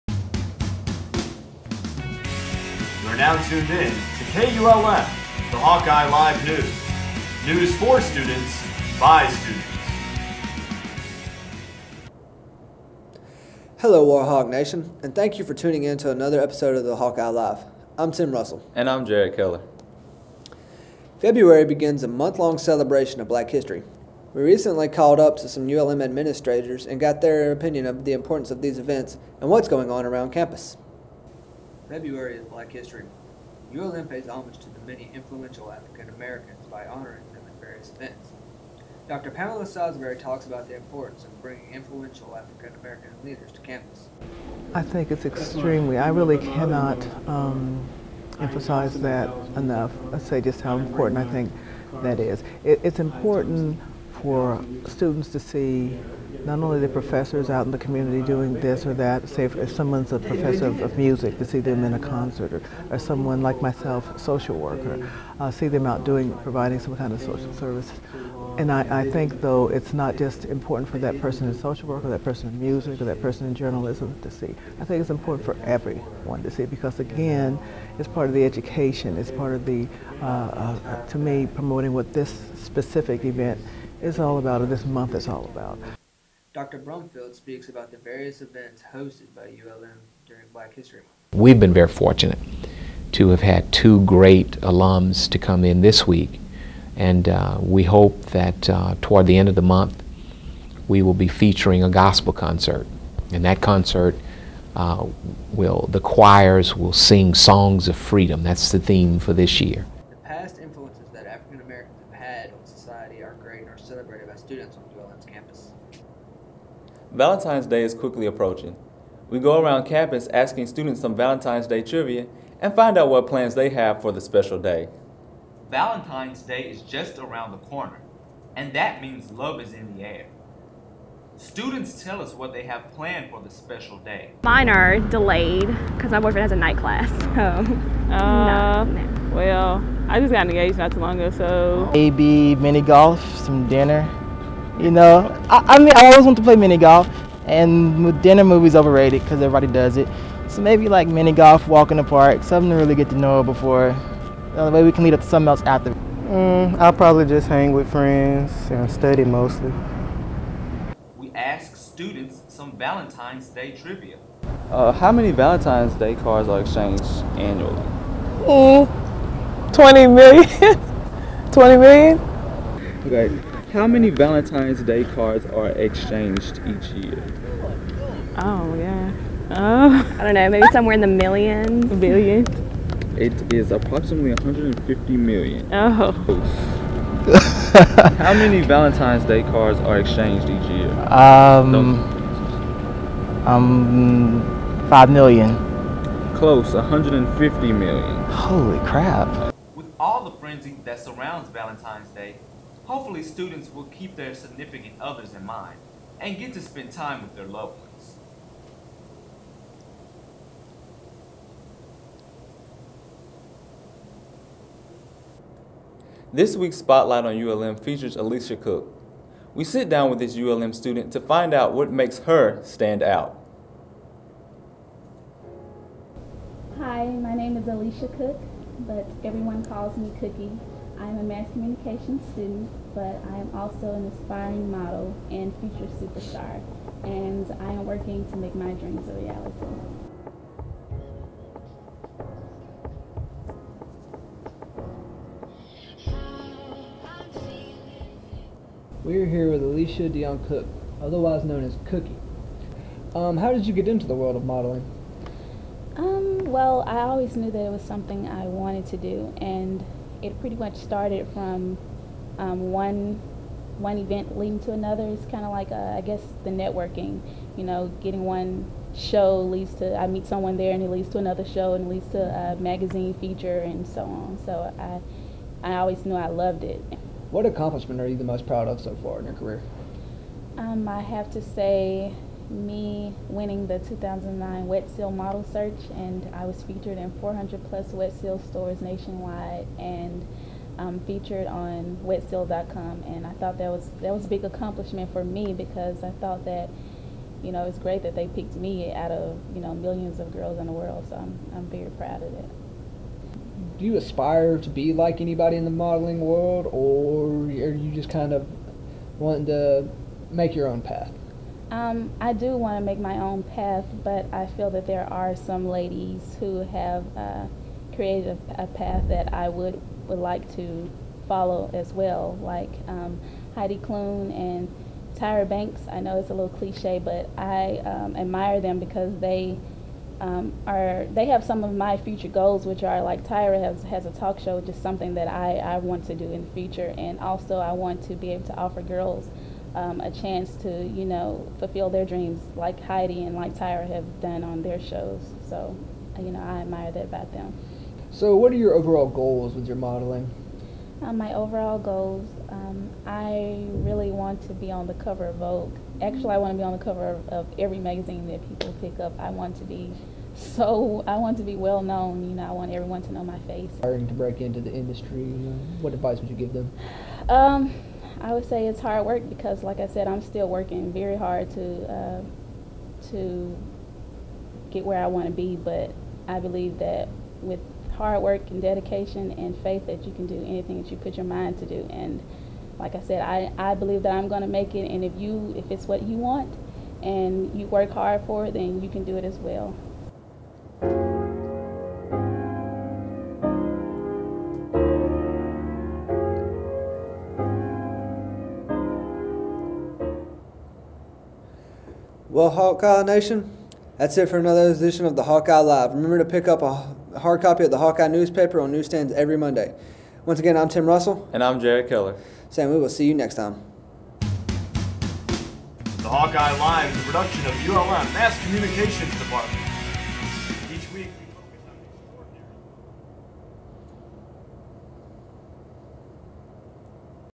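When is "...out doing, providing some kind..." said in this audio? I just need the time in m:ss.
1:05.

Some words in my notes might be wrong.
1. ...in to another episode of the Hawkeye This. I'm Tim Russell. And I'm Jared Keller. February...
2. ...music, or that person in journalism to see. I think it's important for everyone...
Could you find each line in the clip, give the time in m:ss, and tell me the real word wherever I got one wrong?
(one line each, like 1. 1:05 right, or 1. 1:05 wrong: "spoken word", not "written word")
1. 0:15 wrong: "Live", not "This"
2. 1:12 right.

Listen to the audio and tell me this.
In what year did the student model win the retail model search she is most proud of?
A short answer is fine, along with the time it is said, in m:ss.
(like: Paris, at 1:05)
2009, at 4:43.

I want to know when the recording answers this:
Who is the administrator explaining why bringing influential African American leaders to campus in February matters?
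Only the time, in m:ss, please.
0:39.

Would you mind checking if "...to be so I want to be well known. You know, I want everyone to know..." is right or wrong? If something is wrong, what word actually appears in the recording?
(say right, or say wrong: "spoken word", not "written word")
right.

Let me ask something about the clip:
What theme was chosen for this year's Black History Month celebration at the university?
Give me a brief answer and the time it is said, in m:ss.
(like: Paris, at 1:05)
Songs of freedom, at 1:47.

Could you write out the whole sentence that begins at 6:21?
And like I said, I, I believe that I'm going to make it.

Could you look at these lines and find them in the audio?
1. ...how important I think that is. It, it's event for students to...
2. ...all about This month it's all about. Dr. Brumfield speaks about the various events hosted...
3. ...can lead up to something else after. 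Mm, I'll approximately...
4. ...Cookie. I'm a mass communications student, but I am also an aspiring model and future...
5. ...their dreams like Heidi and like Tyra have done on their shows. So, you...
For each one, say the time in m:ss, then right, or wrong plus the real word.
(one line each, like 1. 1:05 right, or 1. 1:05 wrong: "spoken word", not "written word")
1. 0:50 wrong: "important", not "event"
2. 1:24 right
3. 2:34 wrong: "probably", not "approximately"
4. 3:50 right
5. 5:41 right.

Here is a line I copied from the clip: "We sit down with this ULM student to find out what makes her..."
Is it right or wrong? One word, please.
right.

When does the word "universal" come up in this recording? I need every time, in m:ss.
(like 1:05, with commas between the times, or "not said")
not said.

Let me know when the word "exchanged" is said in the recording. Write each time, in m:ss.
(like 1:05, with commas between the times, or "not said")
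2:46, 2:55, 3:10.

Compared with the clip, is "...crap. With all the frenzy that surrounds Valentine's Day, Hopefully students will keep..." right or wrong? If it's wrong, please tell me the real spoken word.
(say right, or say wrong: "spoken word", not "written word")
right.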